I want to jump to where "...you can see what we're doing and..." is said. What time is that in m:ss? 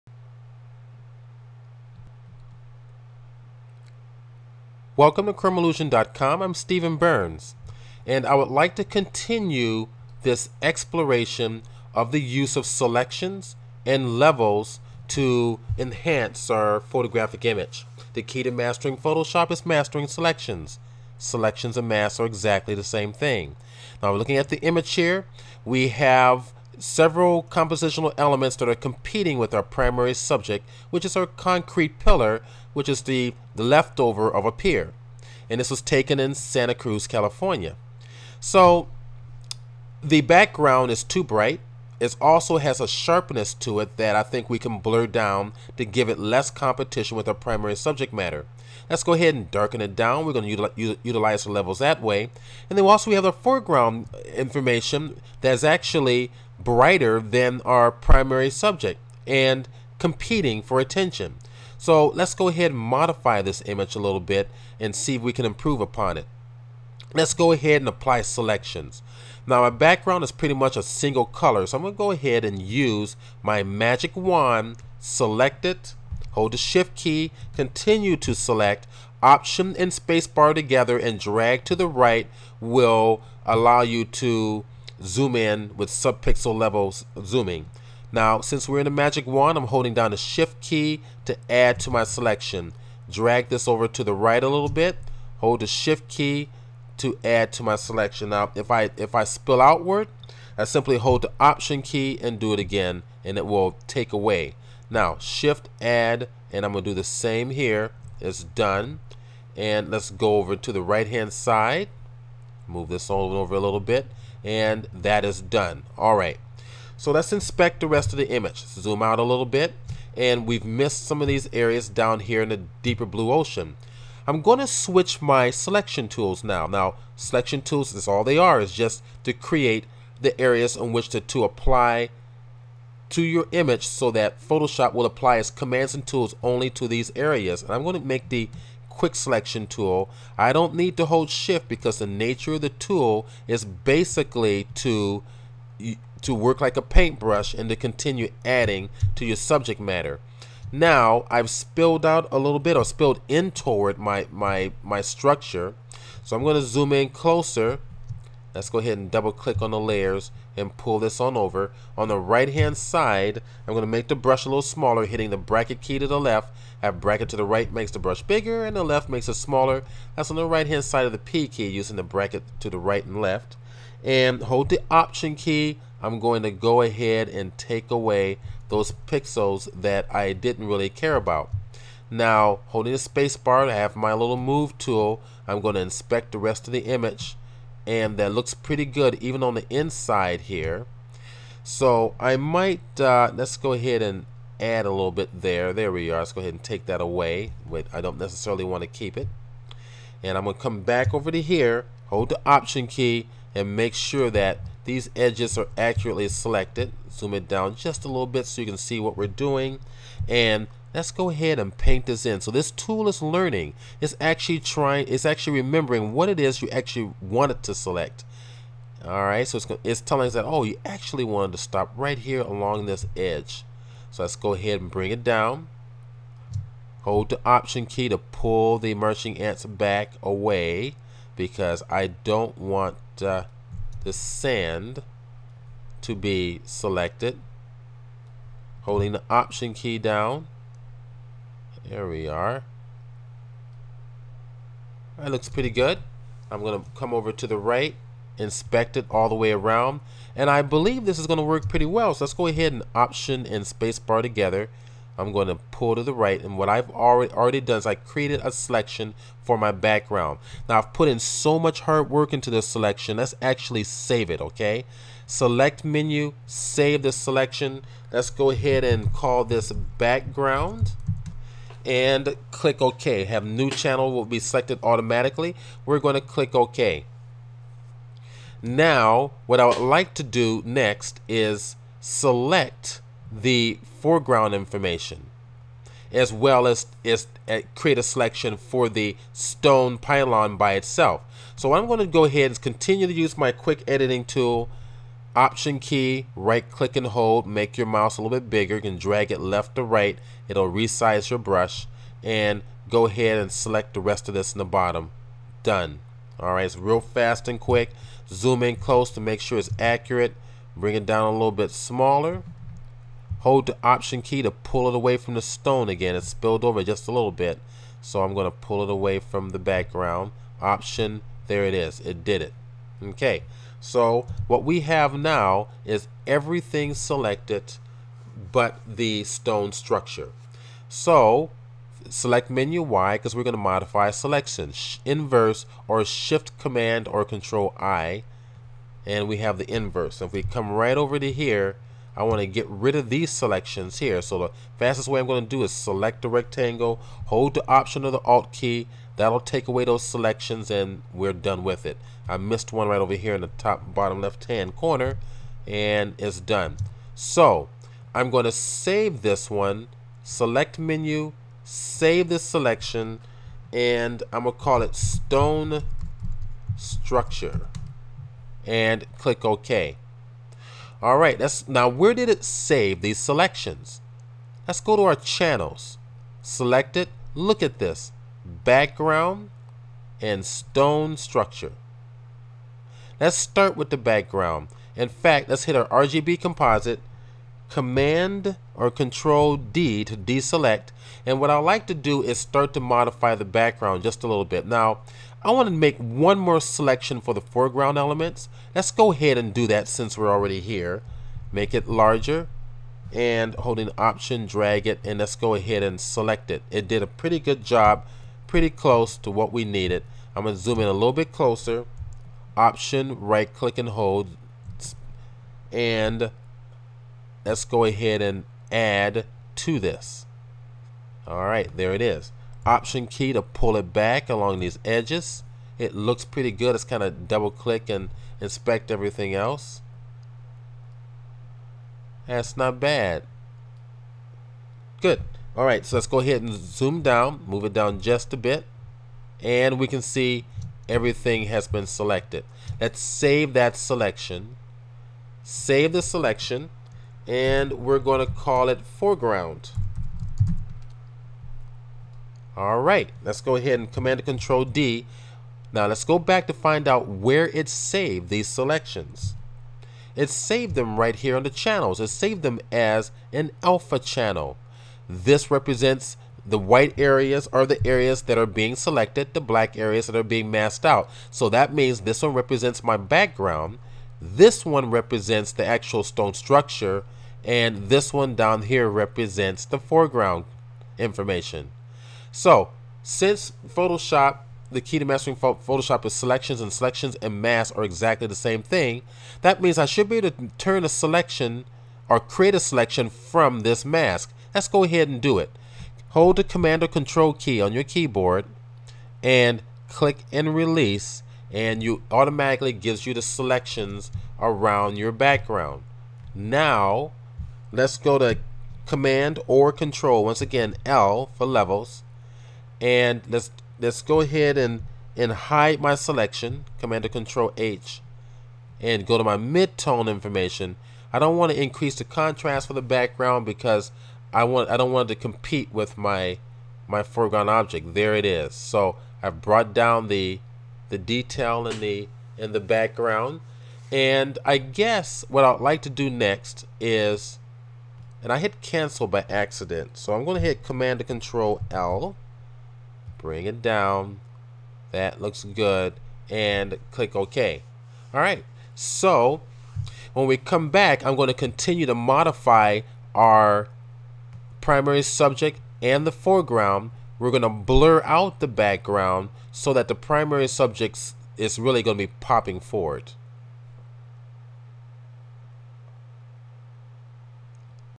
3:28.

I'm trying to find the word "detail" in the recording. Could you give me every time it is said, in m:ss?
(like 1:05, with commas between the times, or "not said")
8:50.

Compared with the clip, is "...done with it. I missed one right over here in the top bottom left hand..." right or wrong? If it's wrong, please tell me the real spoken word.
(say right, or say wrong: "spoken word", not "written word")
right.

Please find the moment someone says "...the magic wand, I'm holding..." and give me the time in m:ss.
1:28.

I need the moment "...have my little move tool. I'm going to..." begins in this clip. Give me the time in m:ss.
3:03.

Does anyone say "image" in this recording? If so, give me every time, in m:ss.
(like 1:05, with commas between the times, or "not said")
0:17, 0:24, 1:03, 1:58, 2:13, 3:06.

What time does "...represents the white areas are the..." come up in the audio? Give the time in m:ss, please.
7:45.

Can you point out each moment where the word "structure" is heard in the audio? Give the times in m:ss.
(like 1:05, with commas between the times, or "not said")
2:35, 5:29, 6:06, 6:21, 7:56.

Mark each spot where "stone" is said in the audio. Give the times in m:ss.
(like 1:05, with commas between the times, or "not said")
4:49, 5:15, 5:29, 6:04, 6:20, 7:56.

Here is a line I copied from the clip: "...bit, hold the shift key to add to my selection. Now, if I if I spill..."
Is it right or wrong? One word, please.
right.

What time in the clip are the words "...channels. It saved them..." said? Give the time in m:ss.
7:41.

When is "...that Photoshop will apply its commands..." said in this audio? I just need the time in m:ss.
2:14.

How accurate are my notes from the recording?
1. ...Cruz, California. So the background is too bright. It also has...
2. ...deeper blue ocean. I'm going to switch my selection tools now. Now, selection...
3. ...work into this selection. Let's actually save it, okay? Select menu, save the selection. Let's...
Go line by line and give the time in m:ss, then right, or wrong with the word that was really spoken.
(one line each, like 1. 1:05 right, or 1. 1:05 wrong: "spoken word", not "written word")
1. 0:36 right
2. 2:02 right
3. 4:22 right.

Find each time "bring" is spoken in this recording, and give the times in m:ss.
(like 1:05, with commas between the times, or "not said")
3:44, 5:10, 9:03.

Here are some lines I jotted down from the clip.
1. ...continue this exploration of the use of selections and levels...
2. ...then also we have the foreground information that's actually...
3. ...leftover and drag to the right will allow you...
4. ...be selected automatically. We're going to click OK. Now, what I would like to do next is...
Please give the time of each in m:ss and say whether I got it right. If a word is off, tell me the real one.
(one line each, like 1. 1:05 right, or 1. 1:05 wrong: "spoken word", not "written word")
1. 0:08 right
2. 0:52 right
3. 1:20 wrong: "together", not "leftover"
4. 4:34 right.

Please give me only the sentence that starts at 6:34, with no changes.
Now, I want to make one more selection for the foreground elements.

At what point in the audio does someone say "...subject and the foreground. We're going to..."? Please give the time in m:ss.
9:15.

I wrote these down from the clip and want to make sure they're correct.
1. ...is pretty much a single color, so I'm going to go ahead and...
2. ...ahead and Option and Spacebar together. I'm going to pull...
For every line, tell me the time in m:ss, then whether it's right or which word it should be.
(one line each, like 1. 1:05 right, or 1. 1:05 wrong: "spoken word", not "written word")
1. 1:10 right
2. 4:12 right.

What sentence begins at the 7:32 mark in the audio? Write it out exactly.
All right, let's go ahead and command and control D.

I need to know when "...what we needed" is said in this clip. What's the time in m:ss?
6:49.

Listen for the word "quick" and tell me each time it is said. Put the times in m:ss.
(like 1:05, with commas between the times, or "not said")
2:18, 4:53, 5:07.